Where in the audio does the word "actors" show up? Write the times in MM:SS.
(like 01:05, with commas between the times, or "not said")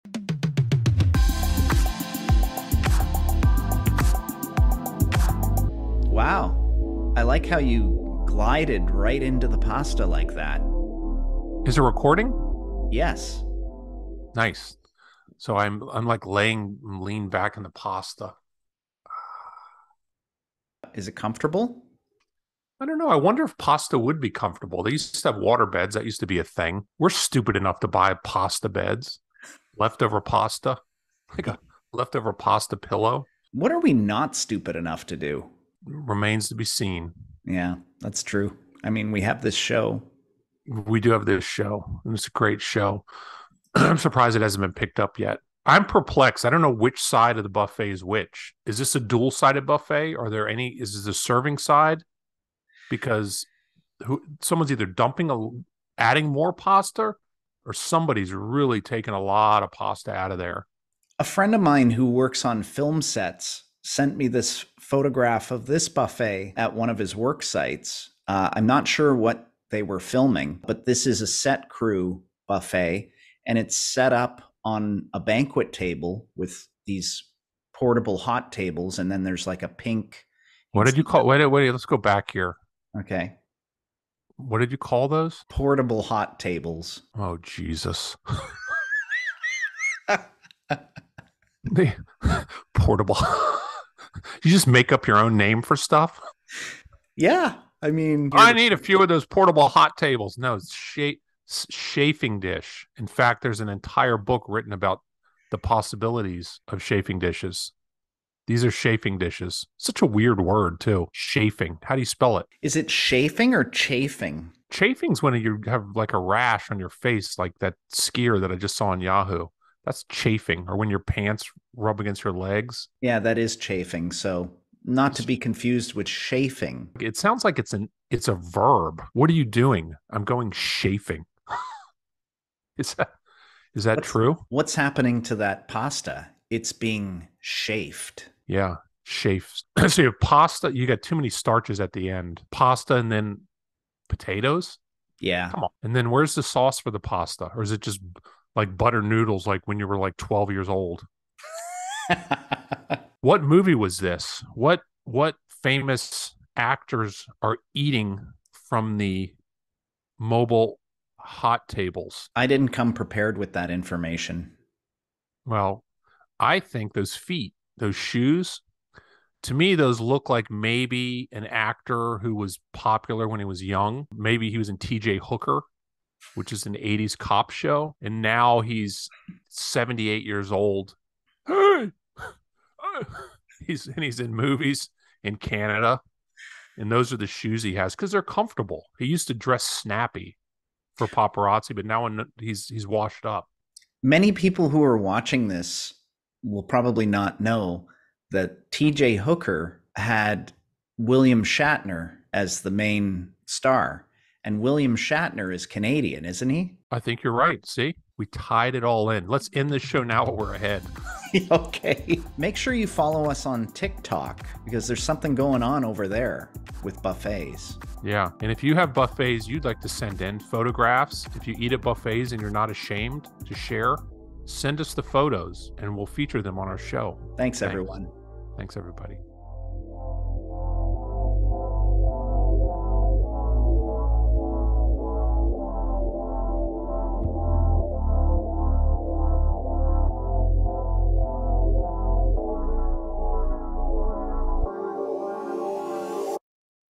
02:36, 02:51.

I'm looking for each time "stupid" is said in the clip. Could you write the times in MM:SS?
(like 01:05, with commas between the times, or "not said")
00:27, 00:34.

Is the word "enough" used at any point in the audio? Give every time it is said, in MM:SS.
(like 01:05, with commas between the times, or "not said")
00:27, 00:34.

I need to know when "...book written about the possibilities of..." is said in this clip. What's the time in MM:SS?
01:44.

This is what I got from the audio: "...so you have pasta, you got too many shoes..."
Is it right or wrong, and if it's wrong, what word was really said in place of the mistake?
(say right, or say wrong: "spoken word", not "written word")
wrong: "starches", not "shoes".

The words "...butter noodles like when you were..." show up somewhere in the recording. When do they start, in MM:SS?
02:28.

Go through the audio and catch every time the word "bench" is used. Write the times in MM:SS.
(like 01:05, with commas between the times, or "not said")
not said.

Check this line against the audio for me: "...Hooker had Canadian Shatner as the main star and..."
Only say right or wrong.
wrong.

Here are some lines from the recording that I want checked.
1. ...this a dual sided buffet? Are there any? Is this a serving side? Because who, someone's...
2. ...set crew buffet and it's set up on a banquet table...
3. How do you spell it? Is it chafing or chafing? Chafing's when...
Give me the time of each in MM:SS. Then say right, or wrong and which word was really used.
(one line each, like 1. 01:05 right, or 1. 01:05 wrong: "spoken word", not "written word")
1. 00:48 right
2. 01:11 right
3. 01:51 right.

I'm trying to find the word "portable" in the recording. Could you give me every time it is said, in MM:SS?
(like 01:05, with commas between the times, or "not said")
01:17, 01:25, 01:32, 01:39.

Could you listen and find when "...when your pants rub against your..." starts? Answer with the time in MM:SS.
02:00.